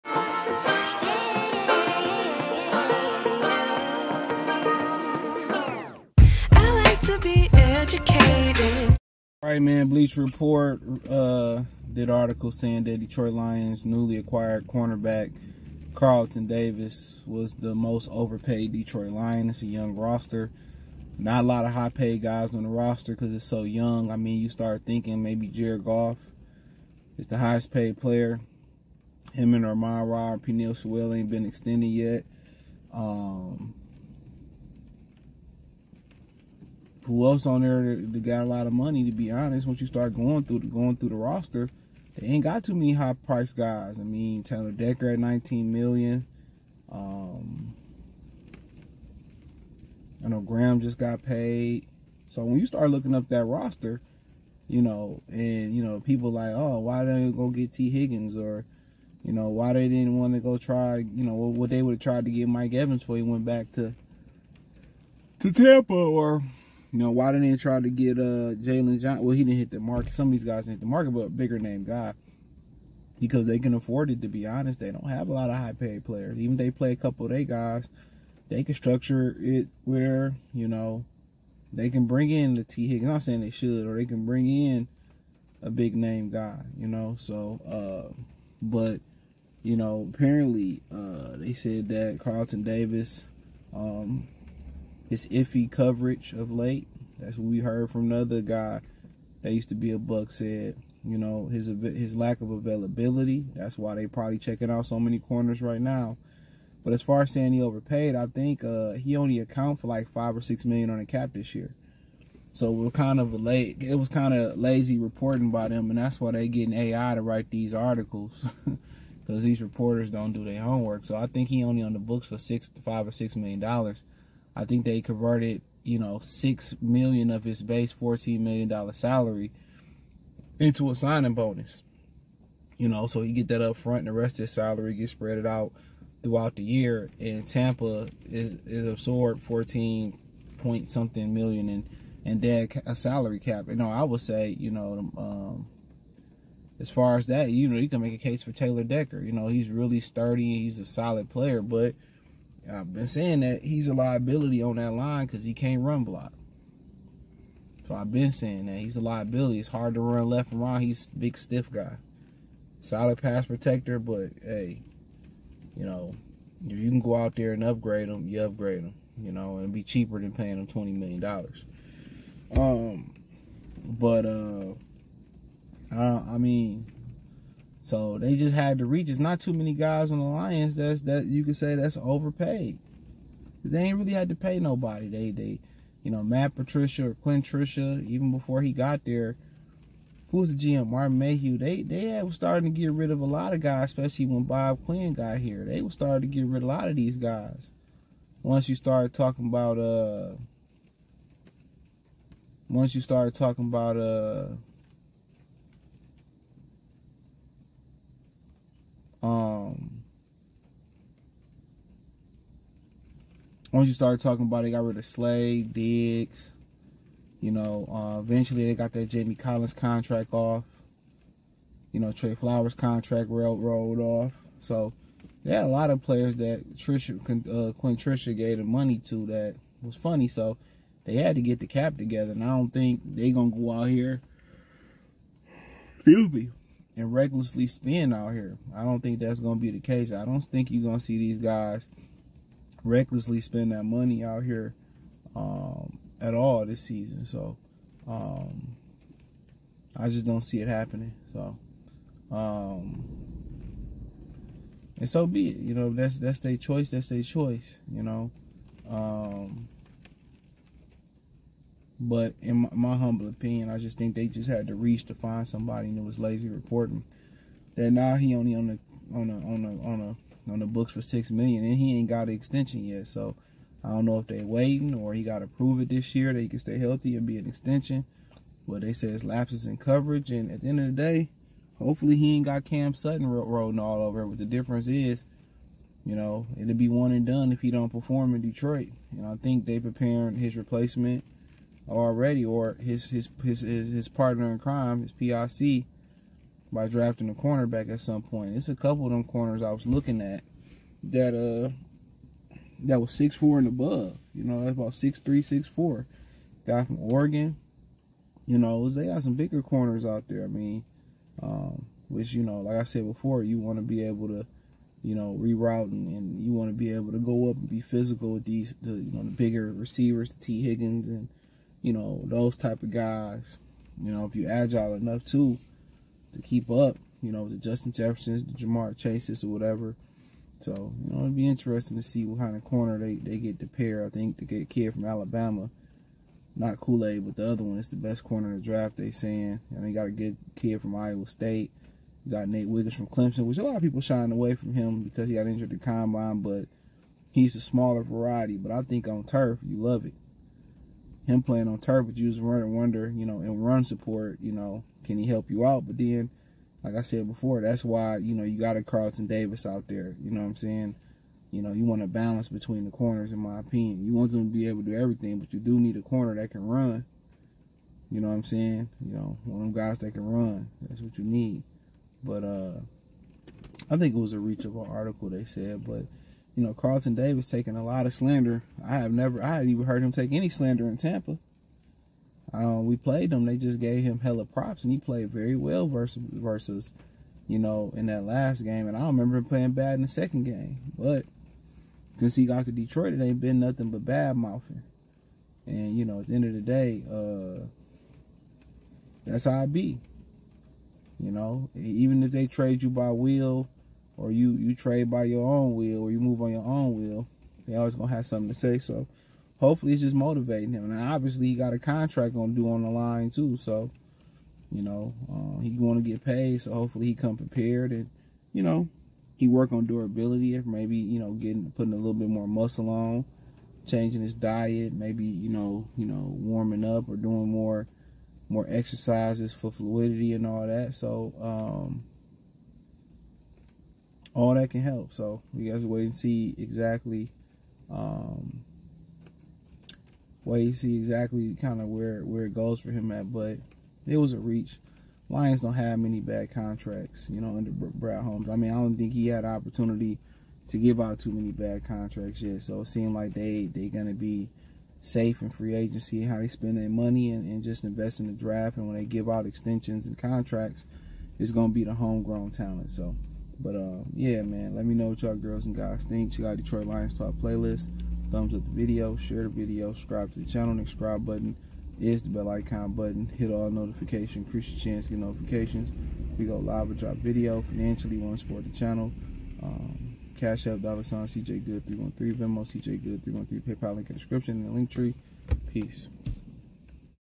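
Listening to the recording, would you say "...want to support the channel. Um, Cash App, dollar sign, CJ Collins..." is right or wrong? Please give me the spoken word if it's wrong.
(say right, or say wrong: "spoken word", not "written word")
wrong: "Good", not "Collins".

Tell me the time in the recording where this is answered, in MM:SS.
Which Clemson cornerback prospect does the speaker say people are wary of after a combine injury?
05:42.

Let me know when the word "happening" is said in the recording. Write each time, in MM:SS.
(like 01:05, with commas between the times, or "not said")
04:10.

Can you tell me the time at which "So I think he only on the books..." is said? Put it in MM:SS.
02:01.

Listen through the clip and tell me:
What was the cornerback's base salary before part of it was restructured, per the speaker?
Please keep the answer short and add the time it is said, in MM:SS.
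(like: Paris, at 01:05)
14 million, at 02:07.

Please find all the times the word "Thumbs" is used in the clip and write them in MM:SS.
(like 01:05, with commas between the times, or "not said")
07:48.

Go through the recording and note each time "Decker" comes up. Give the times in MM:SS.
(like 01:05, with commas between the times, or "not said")
00:44, 02:28.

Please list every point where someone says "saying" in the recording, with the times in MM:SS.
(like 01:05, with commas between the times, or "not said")
00:12, 01:23, 01:47, 02:33, 02:38, 05:39, 06:00, 06:08.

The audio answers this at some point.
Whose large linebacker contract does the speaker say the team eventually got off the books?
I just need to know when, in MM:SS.
03:39.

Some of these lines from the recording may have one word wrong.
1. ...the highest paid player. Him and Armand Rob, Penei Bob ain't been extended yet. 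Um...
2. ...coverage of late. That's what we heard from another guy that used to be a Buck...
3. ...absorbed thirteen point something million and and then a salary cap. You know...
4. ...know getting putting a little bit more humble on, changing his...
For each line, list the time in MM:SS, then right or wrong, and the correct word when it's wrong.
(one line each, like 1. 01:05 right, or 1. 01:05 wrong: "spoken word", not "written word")
1. 00:27 wrong: "Sewell", not "Bob"
2. 01:35 right
3. 02:18 wrong: "fourteen", not "thirteen"
4. 07:01 wrong: "muscle", not "humble".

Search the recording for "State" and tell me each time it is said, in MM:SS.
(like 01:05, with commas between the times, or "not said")
05:41.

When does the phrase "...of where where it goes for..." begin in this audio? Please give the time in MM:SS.
07:21.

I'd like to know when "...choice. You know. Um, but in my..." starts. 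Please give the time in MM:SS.
04:17.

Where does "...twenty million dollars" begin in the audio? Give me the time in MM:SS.
02:50.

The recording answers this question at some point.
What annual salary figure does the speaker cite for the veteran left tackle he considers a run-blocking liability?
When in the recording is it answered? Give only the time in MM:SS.
00:45.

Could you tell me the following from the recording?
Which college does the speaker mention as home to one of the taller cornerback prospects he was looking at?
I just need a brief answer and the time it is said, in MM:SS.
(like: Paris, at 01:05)
Oregon, at 05:06.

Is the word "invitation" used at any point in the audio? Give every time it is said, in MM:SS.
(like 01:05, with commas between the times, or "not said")
not said.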